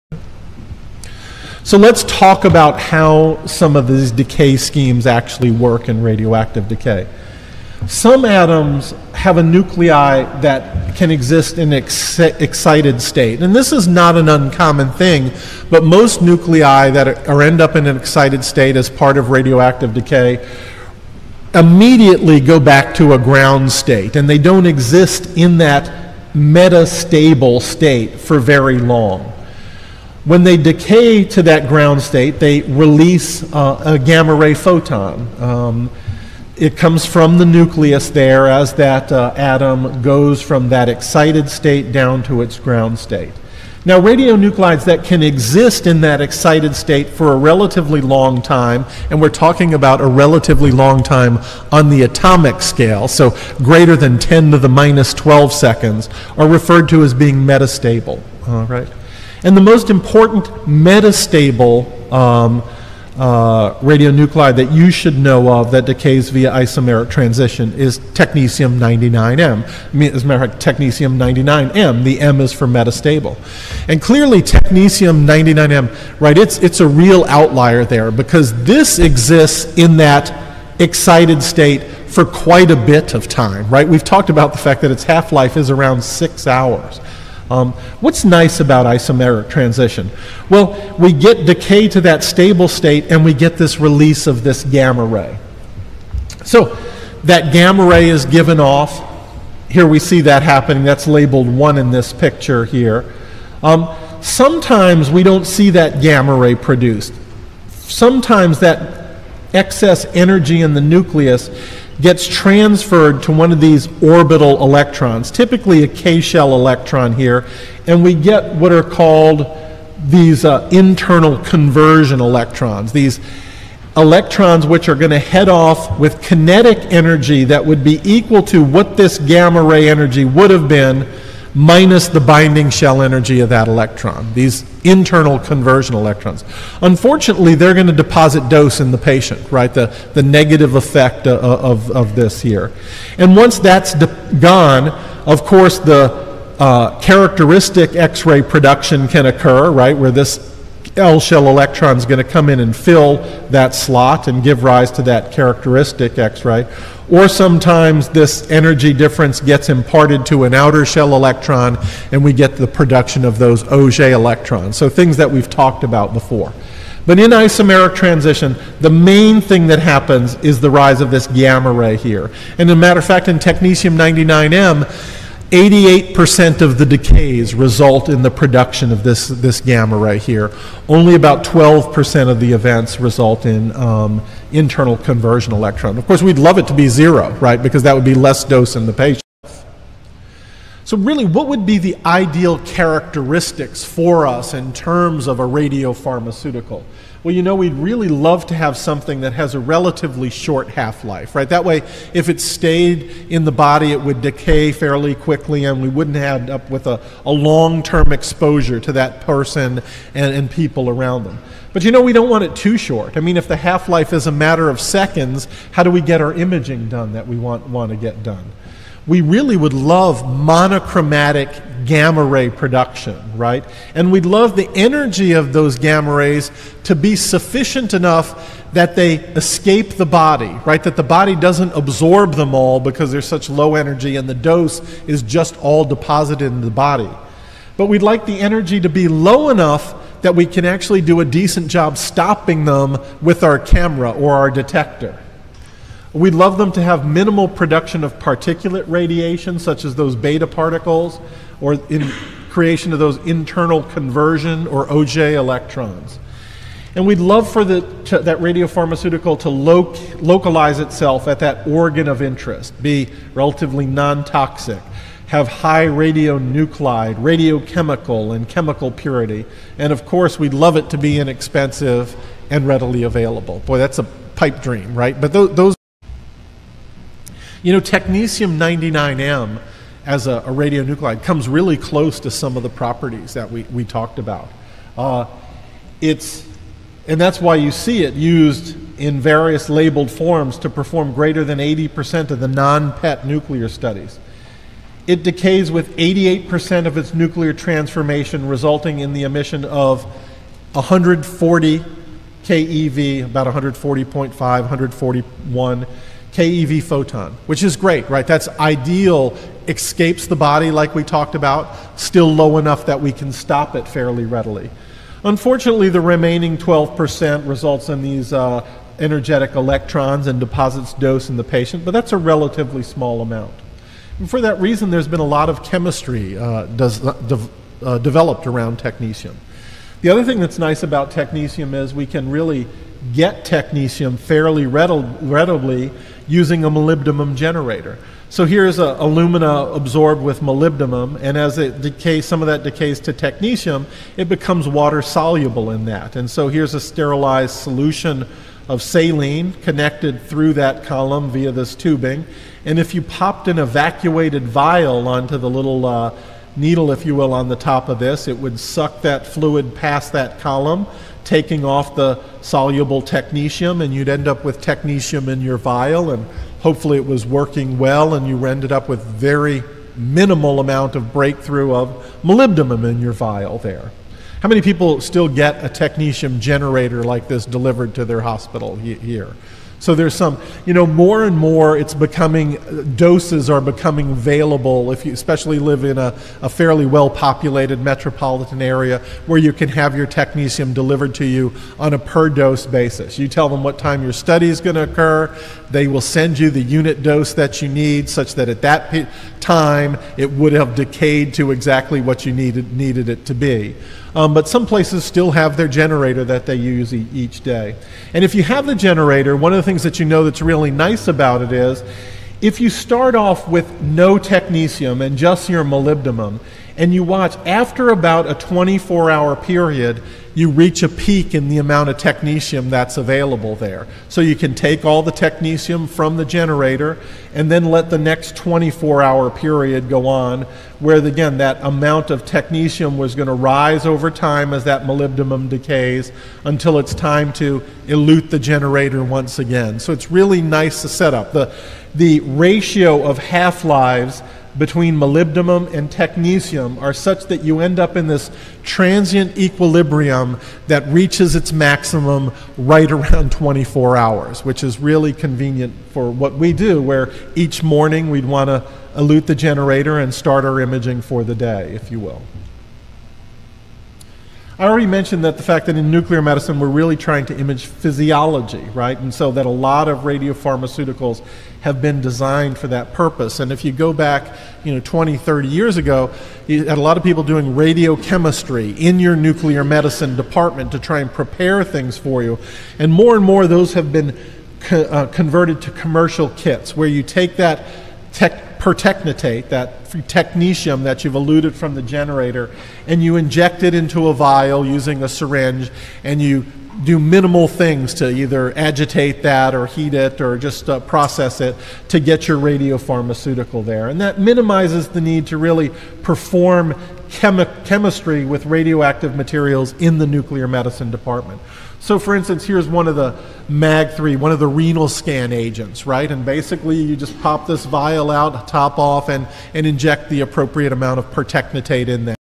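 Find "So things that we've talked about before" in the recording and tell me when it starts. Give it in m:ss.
2:44.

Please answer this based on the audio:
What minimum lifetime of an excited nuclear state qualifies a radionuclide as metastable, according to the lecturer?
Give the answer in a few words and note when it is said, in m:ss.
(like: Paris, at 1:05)
10^-12 seconds, at 0:54.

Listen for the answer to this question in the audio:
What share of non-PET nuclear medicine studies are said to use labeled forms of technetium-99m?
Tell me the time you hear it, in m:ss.
4:51.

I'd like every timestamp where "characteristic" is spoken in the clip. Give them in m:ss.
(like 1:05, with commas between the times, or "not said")
2:27, 2:35, 3:12.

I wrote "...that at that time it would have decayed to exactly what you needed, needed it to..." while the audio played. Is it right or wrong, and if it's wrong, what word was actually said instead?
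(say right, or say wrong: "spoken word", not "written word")
right.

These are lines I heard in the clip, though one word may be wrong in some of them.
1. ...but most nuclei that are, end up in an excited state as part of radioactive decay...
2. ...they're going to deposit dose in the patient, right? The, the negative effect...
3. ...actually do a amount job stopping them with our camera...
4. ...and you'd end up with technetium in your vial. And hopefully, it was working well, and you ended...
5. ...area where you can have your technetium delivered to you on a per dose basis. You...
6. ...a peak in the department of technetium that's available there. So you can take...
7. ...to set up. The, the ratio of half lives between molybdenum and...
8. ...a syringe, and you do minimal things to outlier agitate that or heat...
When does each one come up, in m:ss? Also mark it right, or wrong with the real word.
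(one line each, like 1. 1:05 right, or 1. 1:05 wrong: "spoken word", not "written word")
1. 0:15 right
2. 2:17 right
3. 4:00 wrong: "decent", not "amount"
4. 6:03 right
5. 6:28 right
6. 7:00 wrong: "amount", not "department"
7. 7:20 right
8. 8:15 wrong: "either", not "outlier".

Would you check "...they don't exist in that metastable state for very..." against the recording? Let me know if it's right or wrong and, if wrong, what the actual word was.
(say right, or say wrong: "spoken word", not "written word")
right.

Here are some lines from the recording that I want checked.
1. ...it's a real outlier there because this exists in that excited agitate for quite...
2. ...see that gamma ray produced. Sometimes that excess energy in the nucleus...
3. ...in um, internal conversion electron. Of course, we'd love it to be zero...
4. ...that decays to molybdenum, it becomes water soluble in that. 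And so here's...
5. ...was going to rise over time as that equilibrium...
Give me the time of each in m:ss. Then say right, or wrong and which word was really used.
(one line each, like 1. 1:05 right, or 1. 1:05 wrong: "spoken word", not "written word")
1. 1:16 wrong: "state", not "agitate"
2. 1:45 right
3. 3:03 right
4. 5:42 wrong: "technetium", not "molybdenum"
5. 7:12 wrong: "molybdenum", not "equilibrium".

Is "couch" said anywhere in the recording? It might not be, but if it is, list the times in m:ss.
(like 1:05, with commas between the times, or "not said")
not said.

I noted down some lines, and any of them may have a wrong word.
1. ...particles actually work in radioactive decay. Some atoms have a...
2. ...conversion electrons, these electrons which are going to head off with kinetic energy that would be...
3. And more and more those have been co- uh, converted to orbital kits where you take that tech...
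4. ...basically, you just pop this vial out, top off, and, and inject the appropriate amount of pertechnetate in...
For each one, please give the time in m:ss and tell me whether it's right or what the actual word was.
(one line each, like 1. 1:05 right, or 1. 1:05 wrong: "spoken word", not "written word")
1. 0:04 wrong: "schemes", not "particles"
2. 2:01 right
3. 8:02 wrong: "commercial", not "orbital"
4. 8:36 right.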